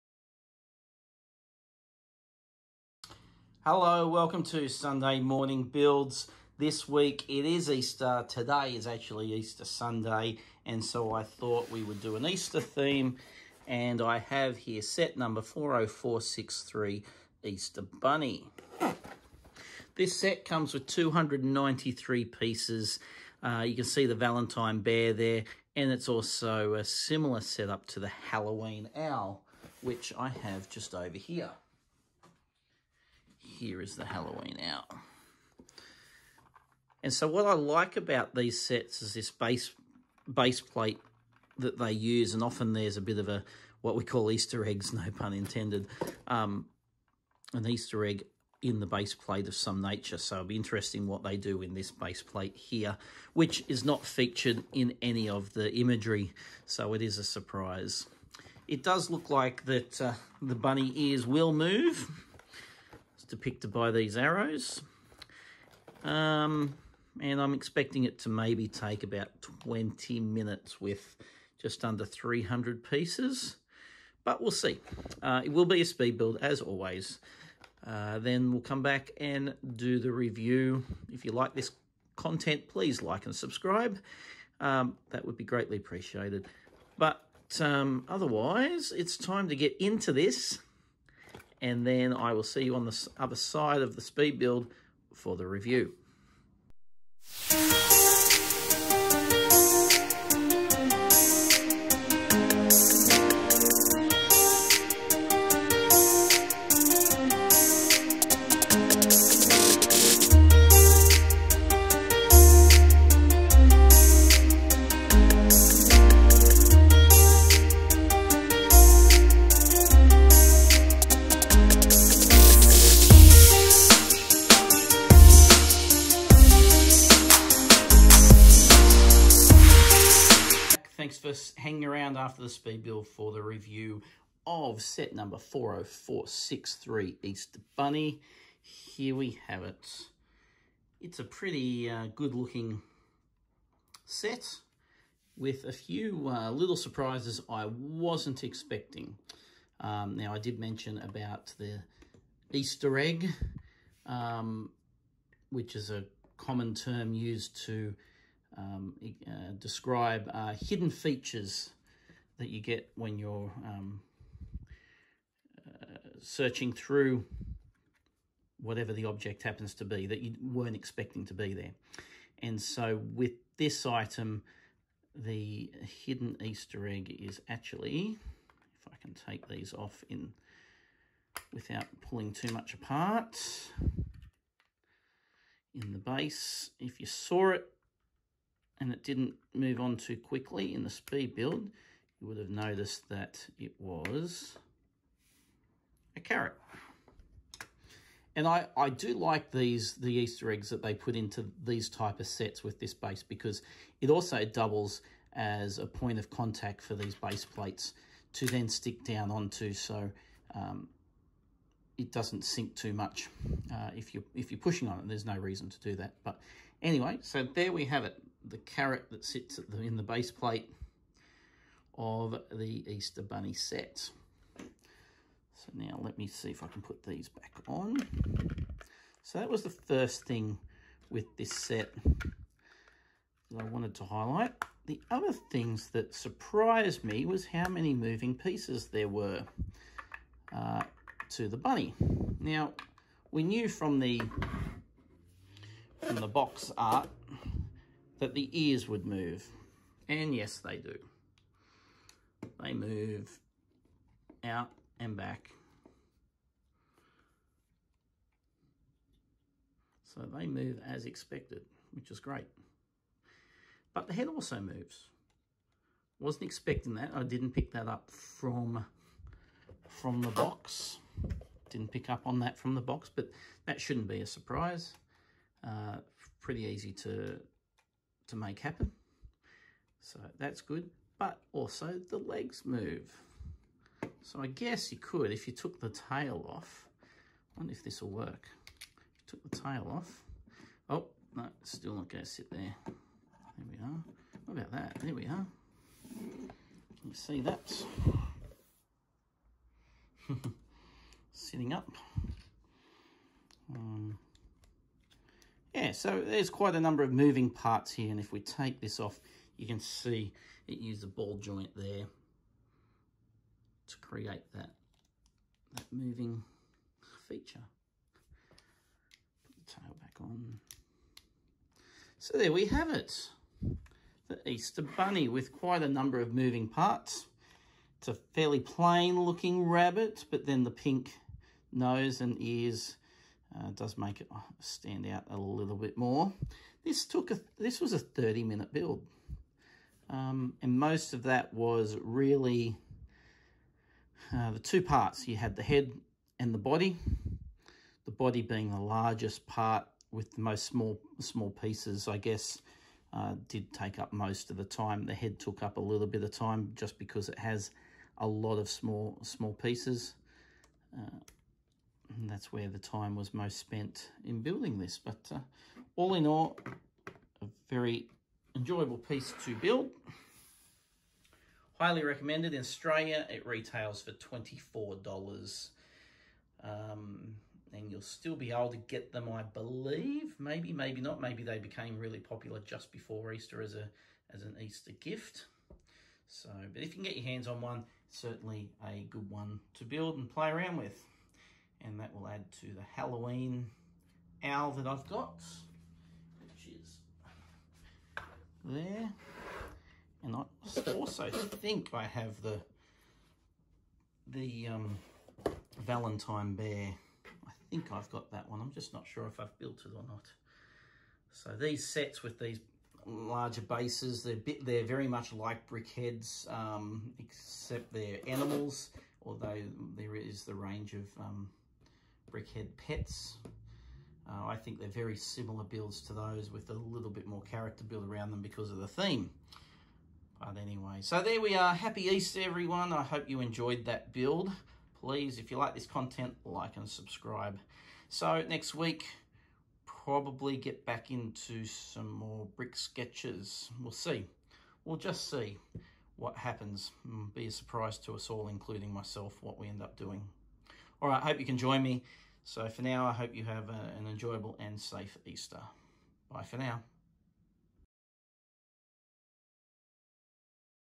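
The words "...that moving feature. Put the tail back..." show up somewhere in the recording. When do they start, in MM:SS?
05:15.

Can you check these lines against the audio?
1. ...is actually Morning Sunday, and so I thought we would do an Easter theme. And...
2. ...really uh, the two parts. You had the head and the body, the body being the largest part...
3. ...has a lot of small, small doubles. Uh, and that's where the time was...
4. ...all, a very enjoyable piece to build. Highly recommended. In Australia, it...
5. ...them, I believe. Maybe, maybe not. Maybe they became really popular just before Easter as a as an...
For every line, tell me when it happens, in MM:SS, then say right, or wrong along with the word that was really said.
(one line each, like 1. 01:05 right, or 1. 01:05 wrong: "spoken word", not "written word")
1. 00:08 wrong: "Easter", not "Morning"
2. 05:42 right
3. 05:57 wrong: "pieces", not "doubles"
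4. 06:06 right
5. 06:19 right.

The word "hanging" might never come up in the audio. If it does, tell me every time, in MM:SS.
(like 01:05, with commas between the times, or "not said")
02:11.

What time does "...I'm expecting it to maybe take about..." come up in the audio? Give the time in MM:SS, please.
01:07.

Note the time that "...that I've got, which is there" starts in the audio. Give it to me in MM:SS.
06:34.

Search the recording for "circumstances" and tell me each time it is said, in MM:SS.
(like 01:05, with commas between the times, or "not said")
not said.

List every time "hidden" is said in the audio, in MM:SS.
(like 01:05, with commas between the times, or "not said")
02:40, 02:56.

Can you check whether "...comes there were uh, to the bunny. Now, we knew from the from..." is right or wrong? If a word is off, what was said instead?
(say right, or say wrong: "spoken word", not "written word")
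wrong: "pieces", not "comes".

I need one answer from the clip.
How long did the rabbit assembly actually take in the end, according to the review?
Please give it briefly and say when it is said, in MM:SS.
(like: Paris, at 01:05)
30 minutes, at 05:37.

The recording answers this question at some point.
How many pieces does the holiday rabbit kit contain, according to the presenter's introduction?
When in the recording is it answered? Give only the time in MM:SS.
00:20.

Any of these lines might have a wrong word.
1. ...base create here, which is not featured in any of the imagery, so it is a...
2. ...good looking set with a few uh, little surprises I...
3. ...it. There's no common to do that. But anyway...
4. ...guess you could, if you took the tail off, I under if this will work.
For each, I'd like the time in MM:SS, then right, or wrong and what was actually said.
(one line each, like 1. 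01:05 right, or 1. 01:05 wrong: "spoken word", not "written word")
1. 00:51 wrong: "plate", not "create"
2. 02:22 right
3. 03:34 wrong: "reason", not "common"
4. 04:44 wrong: "wonder", not "under".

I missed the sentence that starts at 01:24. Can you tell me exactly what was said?
Um, that would be greatly appreciated.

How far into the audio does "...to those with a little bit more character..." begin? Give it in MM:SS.
07:06.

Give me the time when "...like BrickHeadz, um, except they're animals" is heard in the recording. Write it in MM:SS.
06:55.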